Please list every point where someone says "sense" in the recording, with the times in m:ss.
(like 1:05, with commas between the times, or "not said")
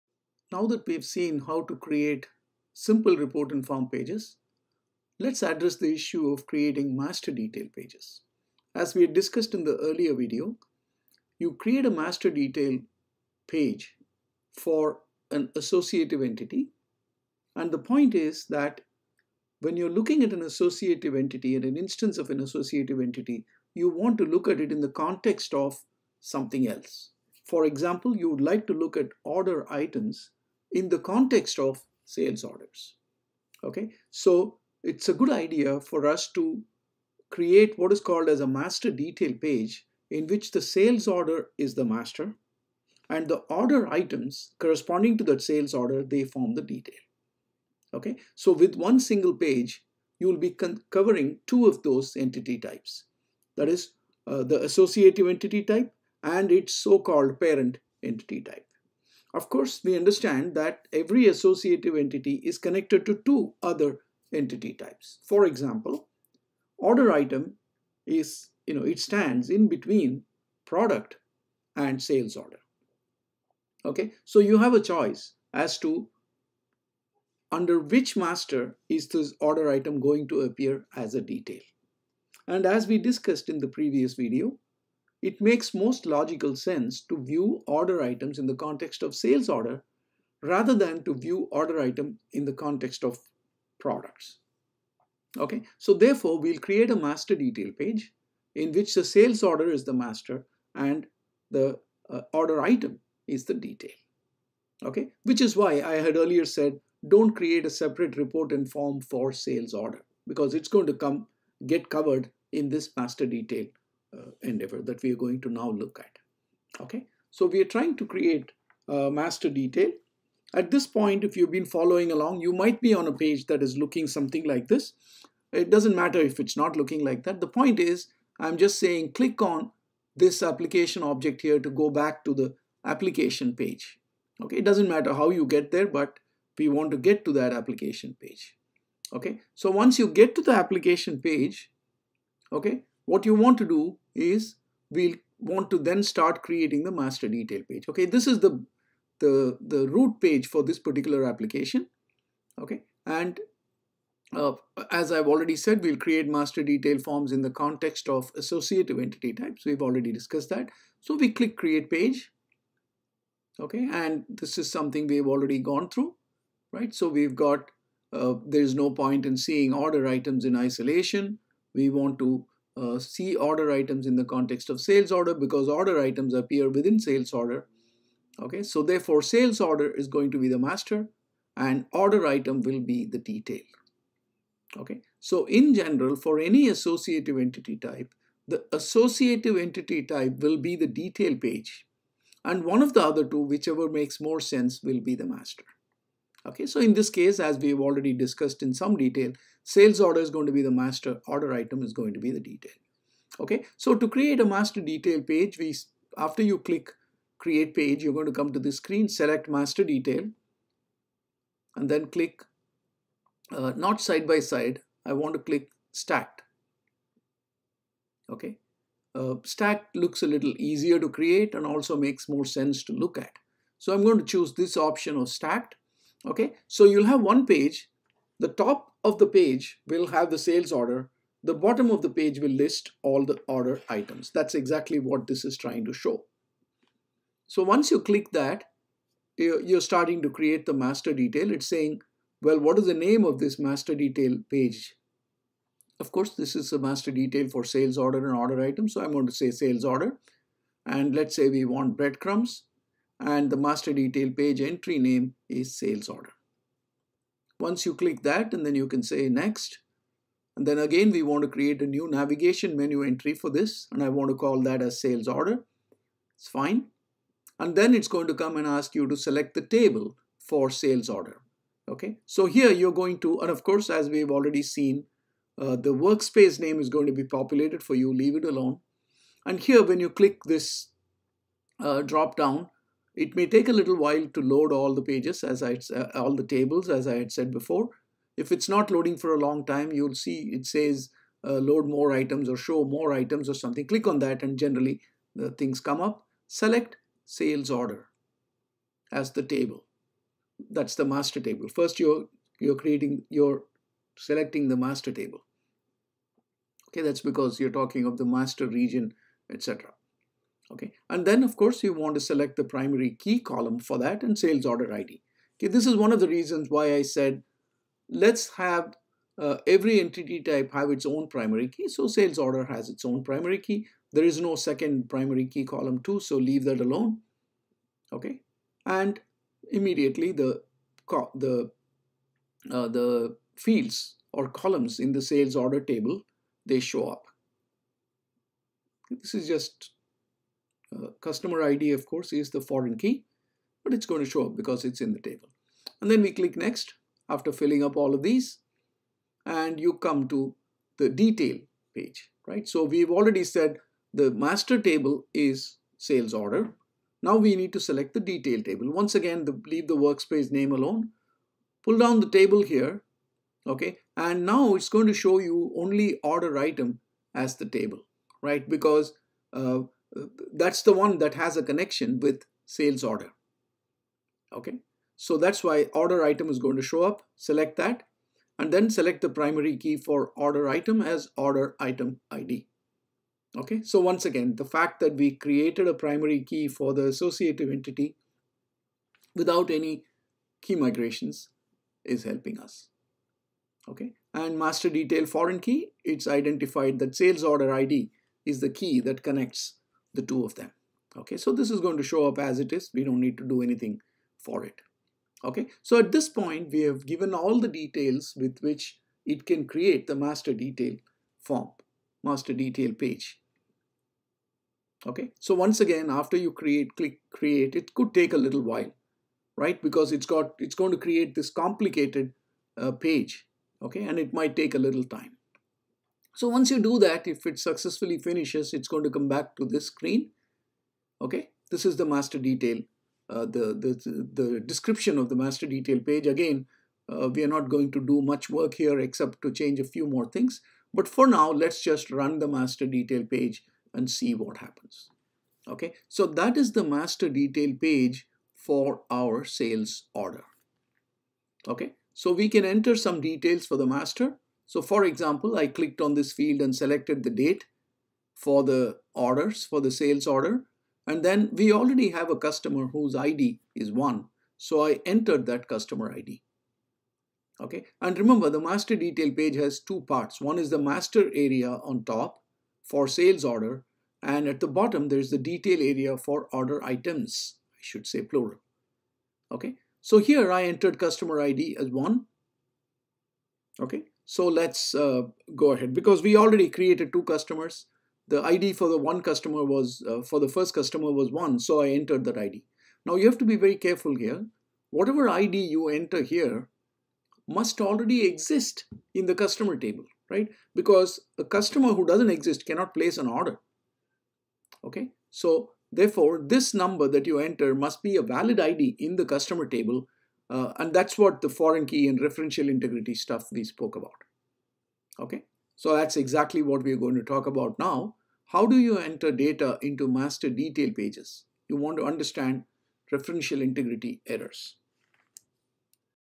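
1:26, 3:14, 3:42.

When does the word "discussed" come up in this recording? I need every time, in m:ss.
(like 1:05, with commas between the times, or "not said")
0:09, 1:22, 2:40, 3:18.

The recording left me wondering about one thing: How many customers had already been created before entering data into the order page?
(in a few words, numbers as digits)
2.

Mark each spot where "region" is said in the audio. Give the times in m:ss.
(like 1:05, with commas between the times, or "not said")
5:08.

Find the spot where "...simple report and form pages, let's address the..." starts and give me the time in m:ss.
0:02.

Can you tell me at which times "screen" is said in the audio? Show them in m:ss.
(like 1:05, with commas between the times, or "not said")
3:28, 7:09.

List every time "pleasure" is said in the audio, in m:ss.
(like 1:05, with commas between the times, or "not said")
not said.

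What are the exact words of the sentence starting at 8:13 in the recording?
Now you have to be very careful here.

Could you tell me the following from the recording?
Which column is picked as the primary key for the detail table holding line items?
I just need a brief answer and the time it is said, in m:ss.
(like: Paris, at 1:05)
Order item ID, at 6:21.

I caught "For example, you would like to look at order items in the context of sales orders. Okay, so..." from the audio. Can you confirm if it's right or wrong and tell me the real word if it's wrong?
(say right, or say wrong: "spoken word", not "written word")
right.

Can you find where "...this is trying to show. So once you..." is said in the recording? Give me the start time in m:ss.
3:55.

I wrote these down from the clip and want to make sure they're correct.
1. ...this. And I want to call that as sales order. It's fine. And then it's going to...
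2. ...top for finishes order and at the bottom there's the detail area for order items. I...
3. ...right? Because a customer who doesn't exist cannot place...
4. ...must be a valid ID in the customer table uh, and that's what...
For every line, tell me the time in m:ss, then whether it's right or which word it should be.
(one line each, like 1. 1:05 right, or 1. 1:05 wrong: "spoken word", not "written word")
1. 4:23 right
2. 7:52 wrong: "sales", not "finishes"
3. 8:20 right
4. 8:27 right.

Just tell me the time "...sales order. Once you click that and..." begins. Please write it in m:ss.
4:15.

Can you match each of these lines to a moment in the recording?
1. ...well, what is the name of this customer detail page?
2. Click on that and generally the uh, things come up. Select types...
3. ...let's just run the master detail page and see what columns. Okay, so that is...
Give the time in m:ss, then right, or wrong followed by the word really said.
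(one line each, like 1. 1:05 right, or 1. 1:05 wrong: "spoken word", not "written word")
1. 4:02 wrong: "master", not "customer"
2. 4:53 wrong: "sales", not "types"
3. 7:21 wrong: "happens", not "columns".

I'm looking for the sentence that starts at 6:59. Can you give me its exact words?
Because it's got, it's going to create this complicated uh, page.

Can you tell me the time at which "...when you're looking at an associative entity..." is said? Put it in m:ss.
0:19.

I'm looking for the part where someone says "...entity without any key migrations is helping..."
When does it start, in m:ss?
6:27.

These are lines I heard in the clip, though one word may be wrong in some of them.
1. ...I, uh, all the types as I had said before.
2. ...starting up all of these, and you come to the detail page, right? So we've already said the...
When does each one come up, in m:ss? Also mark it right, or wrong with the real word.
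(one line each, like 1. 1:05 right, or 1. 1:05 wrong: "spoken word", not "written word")
1. 4:45 wrong: "tables", not "types"
2. 5:47 wrong: "filling", not "starting".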